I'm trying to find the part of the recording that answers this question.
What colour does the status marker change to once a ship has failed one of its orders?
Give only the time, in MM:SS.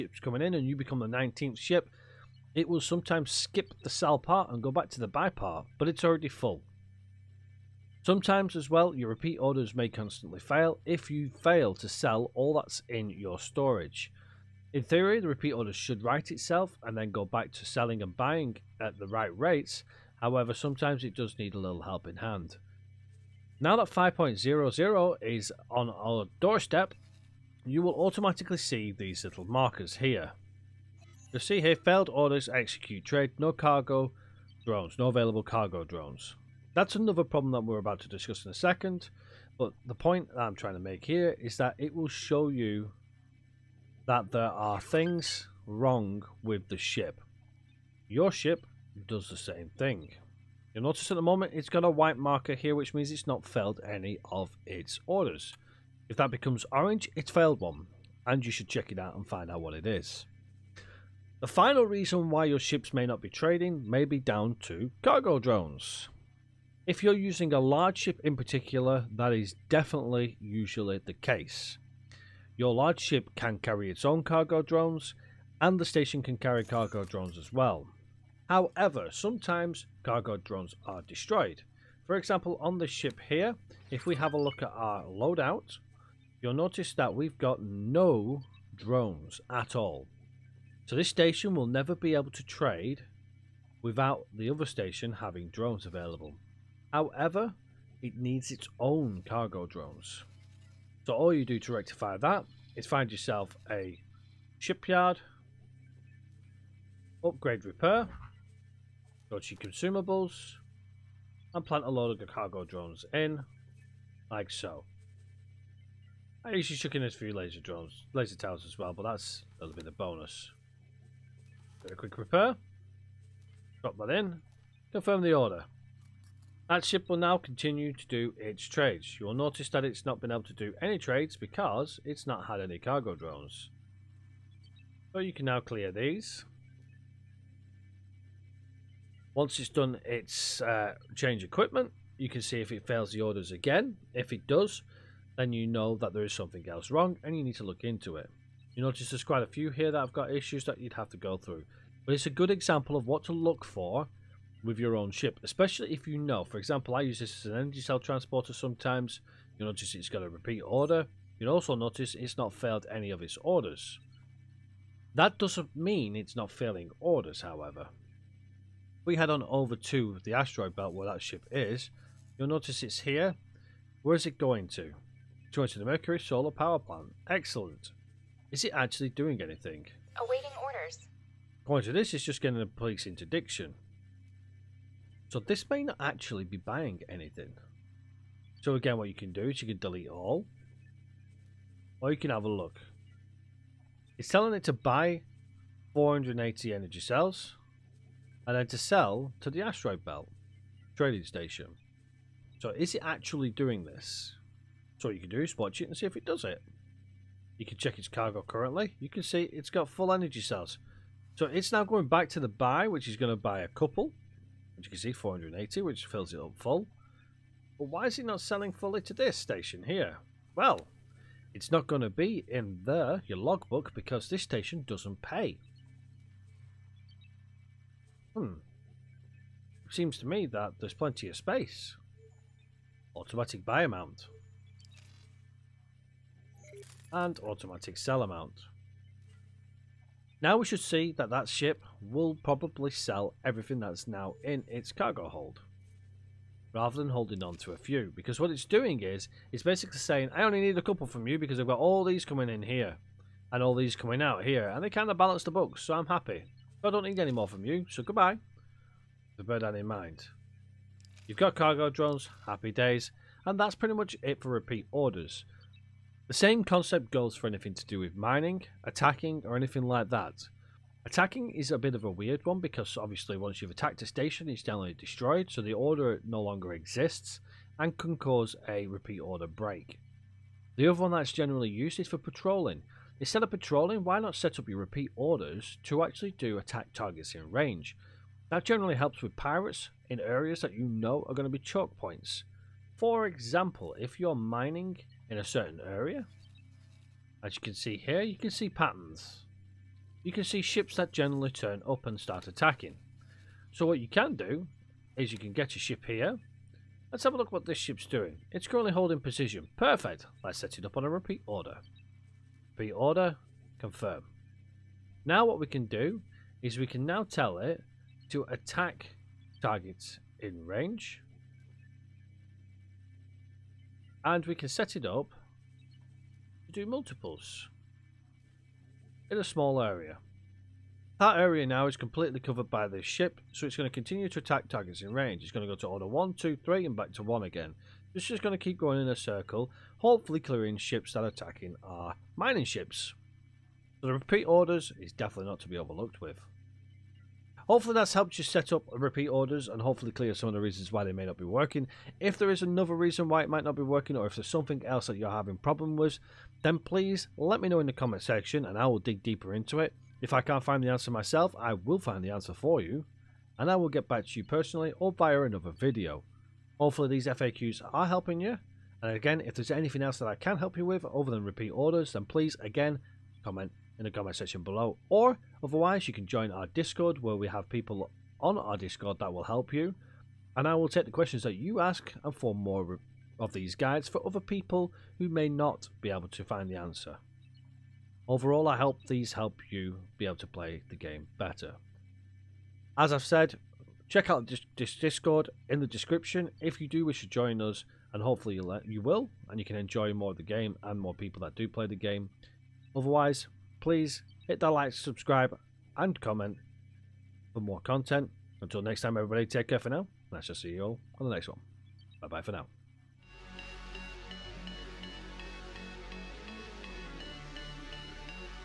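00:56.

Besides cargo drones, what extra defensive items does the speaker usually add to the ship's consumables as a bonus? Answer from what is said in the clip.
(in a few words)
Laser towers.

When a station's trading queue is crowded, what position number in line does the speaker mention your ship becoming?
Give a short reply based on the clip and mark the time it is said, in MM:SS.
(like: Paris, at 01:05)
19th, at 00:01.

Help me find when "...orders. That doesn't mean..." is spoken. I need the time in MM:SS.
02:43.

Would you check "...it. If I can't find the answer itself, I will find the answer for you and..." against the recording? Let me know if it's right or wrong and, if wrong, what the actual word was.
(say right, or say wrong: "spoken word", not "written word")
wrong: "myself", not "itself".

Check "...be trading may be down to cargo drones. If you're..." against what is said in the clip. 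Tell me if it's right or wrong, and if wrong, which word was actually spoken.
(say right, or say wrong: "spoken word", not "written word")
right.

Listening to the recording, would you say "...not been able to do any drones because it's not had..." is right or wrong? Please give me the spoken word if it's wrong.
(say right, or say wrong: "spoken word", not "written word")
wrong: "trades", not "drones".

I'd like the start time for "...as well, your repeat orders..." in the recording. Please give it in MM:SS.
00:08.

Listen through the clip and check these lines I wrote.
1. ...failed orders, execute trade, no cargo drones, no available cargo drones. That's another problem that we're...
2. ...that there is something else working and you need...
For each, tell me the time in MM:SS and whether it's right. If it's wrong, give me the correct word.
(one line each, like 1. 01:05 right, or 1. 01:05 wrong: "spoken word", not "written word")
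1. 00:31 right
2. 02:25 wrong: "wrong", not "working".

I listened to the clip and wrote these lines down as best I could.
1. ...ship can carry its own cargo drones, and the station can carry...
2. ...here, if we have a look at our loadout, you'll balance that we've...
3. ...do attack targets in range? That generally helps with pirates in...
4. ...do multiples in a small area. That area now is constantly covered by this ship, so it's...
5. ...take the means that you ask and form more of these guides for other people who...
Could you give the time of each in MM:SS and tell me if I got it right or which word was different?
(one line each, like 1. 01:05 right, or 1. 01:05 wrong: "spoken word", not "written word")
1. 01:12 right
2. 01:23 wrong: "notice", not "balance"
3. 04:46 right
4. 05:26 wrong: "completely", not "constantly"
5. 06:20 wrong: "questions", not "means".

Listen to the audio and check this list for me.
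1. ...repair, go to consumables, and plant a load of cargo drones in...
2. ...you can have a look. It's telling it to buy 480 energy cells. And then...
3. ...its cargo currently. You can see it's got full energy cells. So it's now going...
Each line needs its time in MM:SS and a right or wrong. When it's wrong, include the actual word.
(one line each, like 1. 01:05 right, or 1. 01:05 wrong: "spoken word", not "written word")
1. 01:47 right
2. 03:12 right
3. 03:27 right.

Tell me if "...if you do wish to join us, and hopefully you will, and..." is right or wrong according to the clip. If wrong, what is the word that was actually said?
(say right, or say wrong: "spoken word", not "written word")
right.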